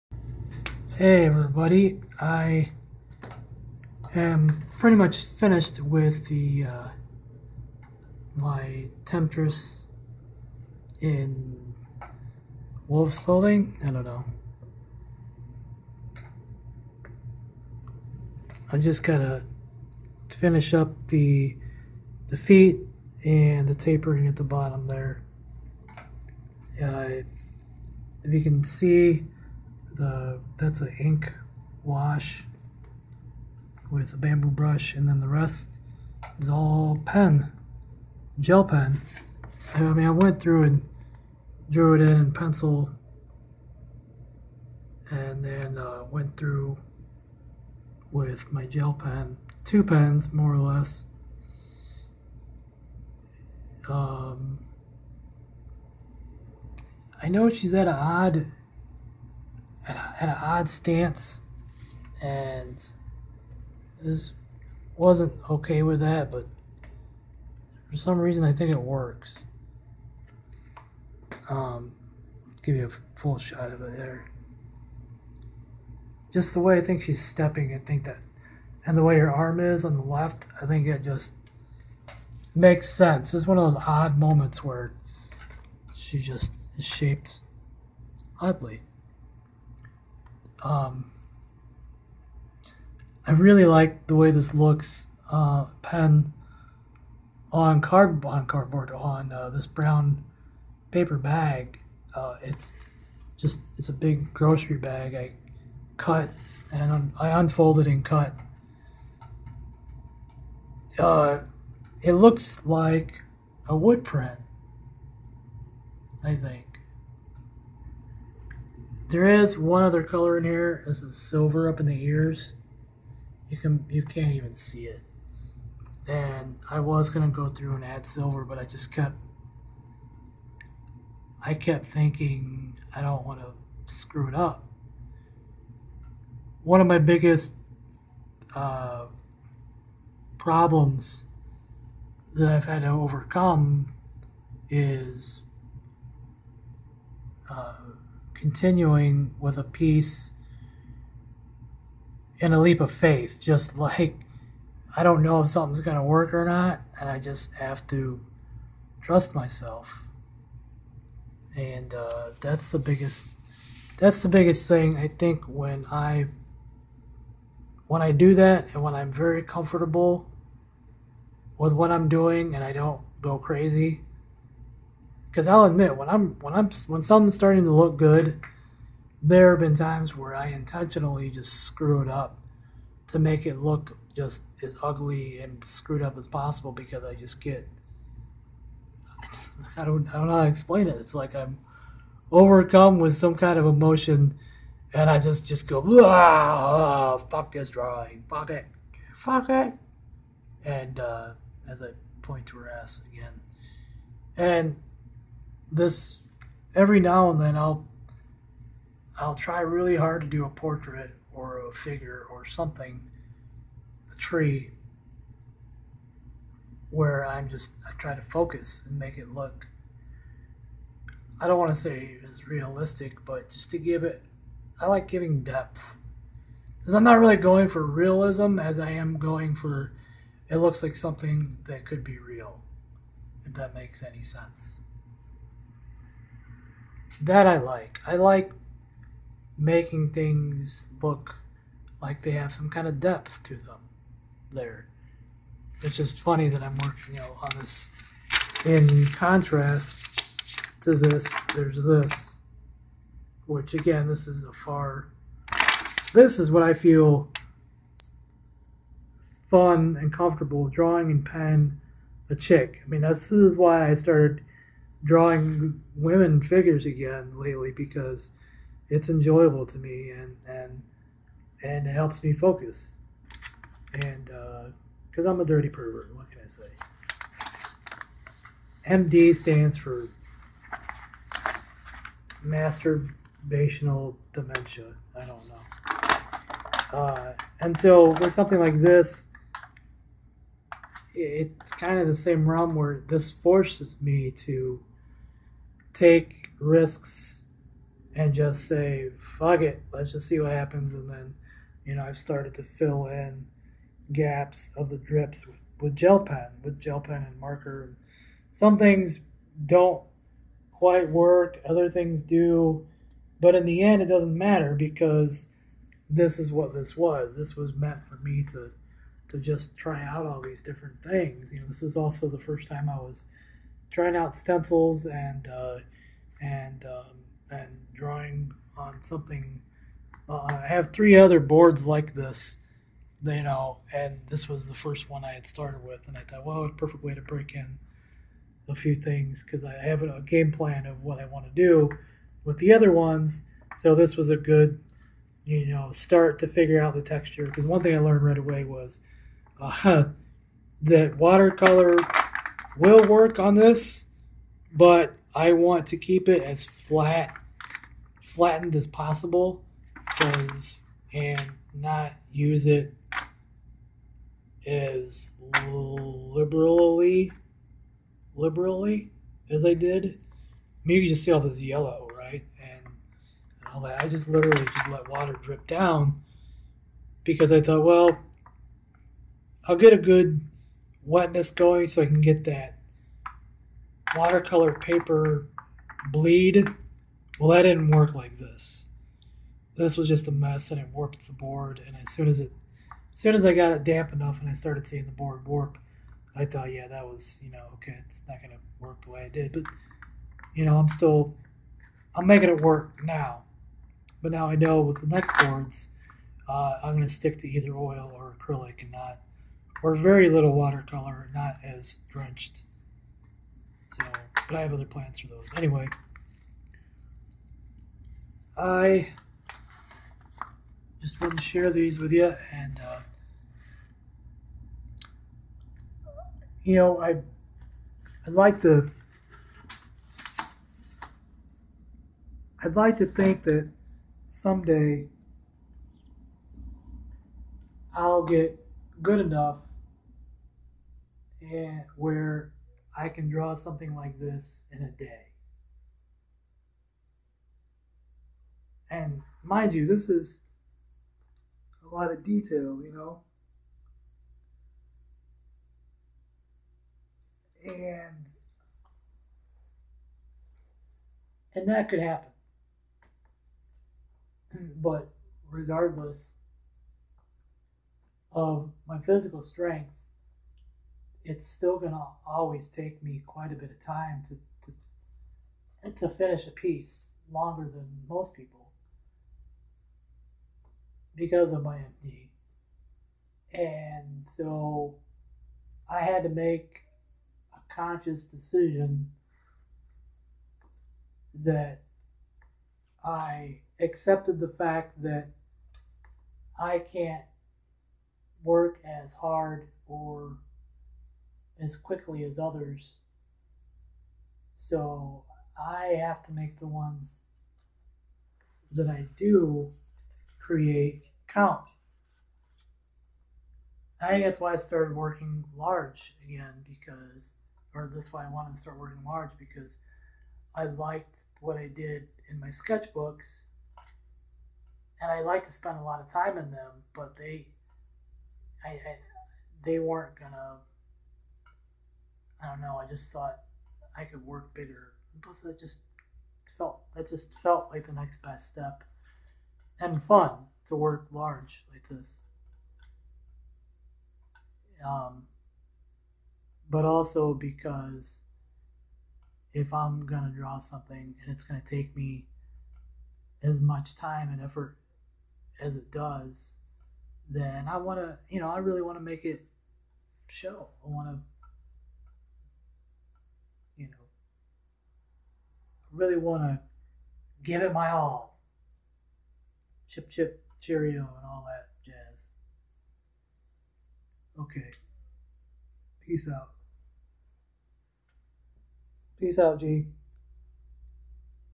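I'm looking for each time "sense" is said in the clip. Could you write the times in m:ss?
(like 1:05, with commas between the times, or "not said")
1:22, 3:54.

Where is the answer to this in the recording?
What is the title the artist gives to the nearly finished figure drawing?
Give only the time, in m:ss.
0:09.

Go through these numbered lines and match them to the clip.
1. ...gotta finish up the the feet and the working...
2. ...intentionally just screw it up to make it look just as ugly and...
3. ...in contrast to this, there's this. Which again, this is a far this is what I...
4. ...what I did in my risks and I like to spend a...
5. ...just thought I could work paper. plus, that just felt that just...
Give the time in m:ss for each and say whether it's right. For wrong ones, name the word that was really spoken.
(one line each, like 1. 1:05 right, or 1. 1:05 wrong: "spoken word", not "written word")
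1. 0:19 wrong: "tapering", not "working"
2. 3:00 right
3. 4:08 right
4. 8:41 wrong: "sketchbooks", not "risks"
5. 8:52 wrong: "bigger", not "paper".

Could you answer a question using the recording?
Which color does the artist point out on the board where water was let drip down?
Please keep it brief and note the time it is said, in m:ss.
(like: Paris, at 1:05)
Yellow, at 6:11.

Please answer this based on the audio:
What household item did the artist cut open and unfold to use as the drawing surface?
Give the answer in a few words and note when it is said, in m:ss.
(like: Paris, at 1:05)
Grocery bag, at 1:44.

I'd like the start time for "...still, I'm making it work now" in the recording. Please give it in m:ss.
6:40.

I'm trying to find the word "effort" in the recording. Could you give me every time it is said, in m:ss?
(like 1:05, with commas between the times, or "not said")
9:14.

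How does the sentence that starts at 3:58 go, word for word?
I like making things look like they have some kind of depth to them there.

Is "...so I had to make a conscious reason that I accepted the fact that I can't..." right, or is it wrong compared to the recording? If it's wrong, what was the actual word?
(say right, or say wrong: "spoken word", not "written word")
wrong: "decision", not "reason".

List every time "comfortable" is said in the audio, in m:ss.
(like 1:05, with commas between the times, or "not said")
2:49, 4:20.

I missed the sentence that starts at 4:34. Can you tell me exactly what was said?
And because uh, I'm a dirty pervert, what can I say?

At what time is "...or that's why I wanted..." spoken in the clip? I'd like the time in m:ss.
8:37.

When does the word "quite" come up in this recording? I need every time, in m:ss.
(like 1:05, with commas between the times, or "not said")
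5:10, 7:53.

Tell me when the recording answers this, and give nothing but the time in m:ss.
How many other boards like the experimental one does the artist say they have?
5:30.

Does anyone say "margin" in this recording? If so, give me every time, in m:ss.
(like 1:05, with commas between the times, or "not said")
not said.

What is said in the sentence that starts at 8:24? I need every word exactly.
So I have to make the ones that I do create count.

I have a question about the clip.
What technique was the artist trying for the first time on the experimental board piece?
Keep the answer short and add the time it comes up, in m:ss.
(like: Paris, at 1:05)
Stencils, at 5:24.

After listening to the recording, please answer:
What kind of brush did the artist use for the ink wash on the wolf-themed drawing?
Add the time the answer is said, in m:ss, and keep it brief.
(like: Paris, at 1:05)
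Bamboo brush, at 0:34.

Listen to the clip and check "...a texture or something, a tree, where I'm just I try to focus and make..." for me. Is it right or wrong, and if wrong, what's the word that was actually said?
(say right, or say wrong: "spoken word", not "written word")
wrong: "figure", not "texture".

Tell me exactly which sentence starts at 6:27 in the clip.
Well, that didn't work like this.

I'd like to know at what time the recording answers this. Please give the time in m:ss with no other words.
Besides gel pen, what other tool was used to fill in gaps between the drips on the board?
5:07.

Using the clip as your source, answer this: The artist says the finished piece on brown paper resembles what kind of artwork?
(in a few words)
Wood print.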